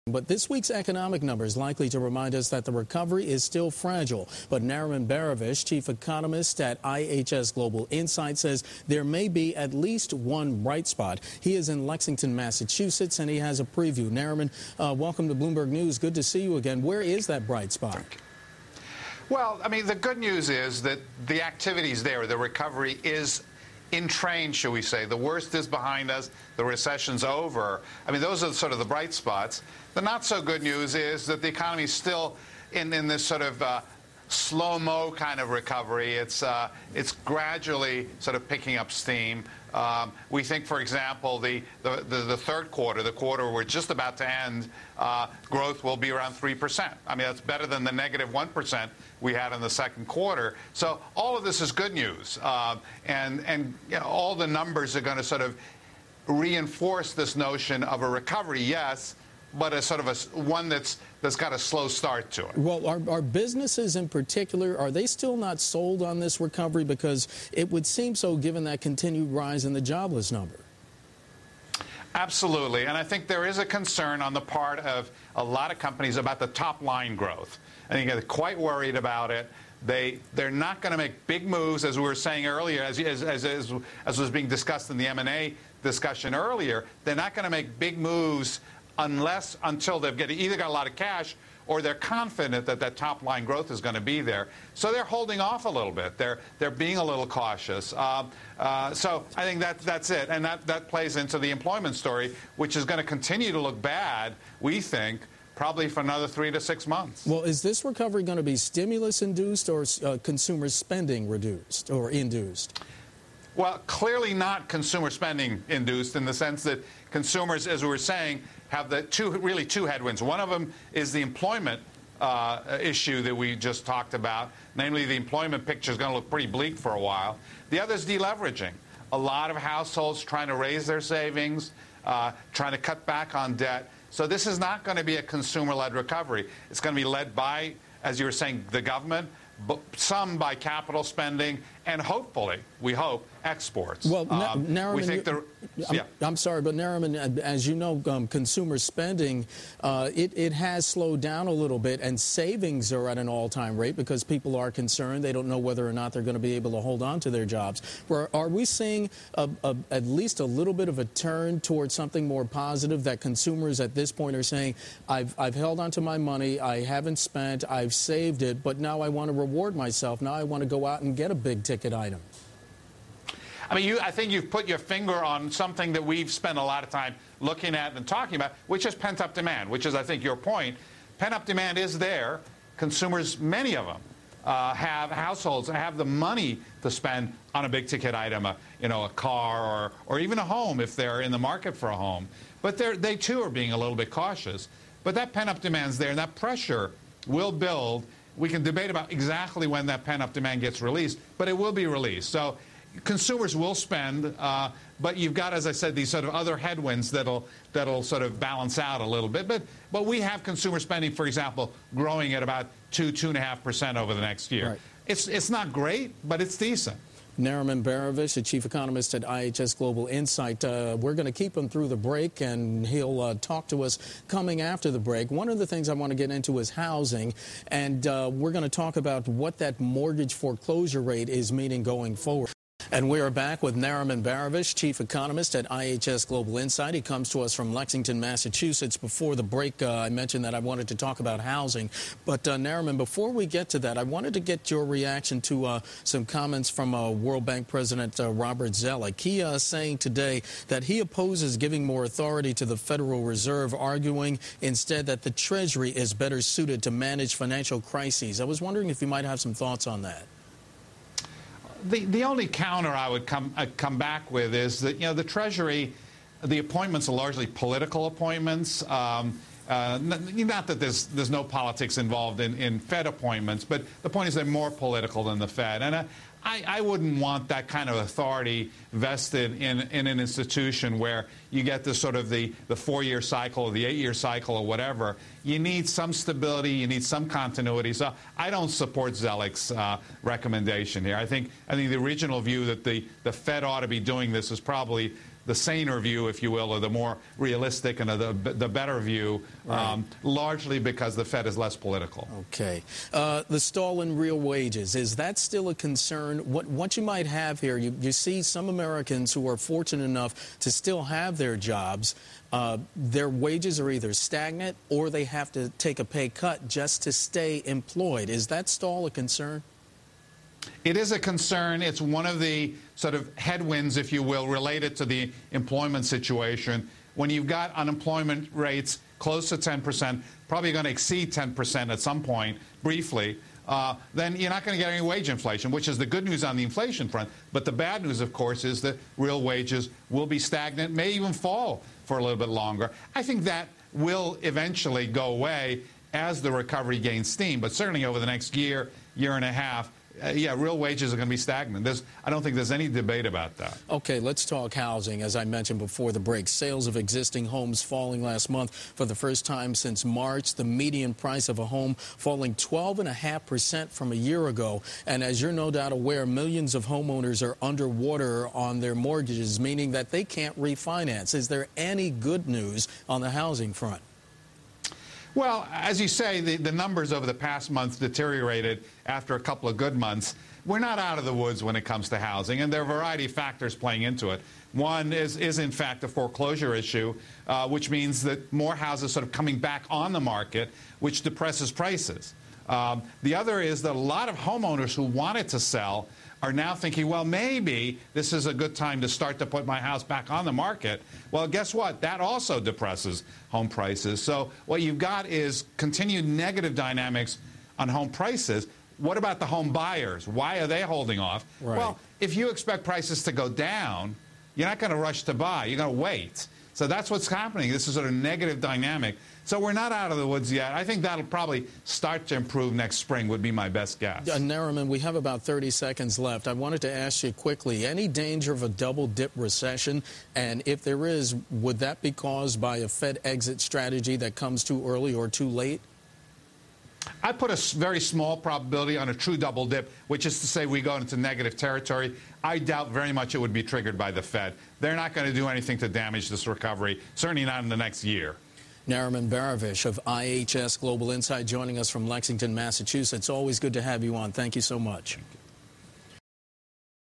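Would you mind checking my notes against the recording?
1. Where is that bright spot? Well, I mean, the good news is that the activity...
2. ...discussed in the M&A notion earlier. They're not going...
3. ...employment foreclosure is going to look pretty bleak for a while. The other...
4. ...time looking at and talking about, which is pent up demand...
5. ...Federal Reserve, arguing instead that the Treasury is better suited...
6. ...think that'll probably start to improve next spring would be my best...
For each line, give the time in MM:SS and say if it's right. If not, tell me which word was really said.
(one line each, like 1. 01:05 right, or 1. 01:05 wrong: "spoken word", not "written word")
1. 00:16 right
2. 01:24 wrong: "discussion", not "notion"
3. 02:05 wrong: "picture", not "foreclosure"
4. 02:56 right
5. 04:12 right
6. 07:00 right.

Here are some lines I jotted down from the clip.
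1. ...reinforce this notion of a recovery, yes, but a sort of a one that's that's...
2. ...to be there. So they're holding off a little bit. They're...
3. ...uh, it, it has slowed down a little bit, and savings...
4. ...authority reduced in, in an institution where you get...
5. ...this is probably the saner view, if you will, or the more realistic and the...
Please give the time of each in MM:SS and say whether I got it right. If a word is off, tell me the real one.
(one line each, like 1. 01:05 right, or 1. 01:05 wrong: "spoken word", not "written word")
1. 00:56 right
2. 01:33 right
3. 02:29 right
4. 04:37 wrong: "vested", not "reduced"
5. 04:54 right.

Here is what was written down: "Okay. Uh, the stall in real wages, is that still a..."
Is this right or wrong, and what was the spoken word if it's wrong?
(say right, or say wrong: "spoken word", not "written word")
right.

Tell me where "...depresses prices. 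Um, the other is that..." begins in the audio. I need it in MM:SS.
06:31.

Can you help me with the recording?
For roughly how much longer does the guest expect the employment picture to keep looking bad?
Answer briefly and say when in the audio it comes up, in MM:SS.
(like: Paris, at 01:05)
3 to 6 months, at 01:46.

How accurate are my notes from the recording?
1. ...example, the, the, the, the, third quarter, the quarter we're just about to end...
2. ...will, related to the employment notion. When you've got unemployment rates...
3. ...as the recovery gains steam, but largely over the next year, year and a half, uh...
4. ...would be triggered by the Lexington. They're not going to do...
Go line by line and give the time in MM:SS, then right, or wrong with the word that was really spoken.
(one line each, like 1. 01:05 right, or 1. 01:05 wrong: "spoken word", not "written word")
1. 00:40 right
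2. 05:24 wrong: "situation", not "notion"
3. 05:46 wrong: "certainly", not "largely"
4. 07:23 wrong: "Fed", not "Lexington".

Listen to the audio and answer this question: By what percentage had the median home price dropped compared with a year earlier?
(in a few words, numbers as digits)
12.5%.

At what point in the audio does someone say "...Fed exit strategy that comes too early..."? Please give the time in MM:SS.
07:12.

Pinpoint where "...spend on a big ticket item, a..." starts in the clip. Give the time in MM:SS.
03:06.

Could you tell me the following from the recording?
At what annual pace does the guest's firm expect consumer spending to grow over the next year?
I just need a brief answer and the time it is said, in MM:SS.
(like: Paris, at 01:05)
2 to 2.5%, at 03:32.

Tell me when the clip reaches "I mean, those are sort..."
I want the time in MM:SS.
00:28.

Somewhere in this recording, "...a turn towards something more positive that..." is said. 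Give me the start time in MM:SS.
02:40.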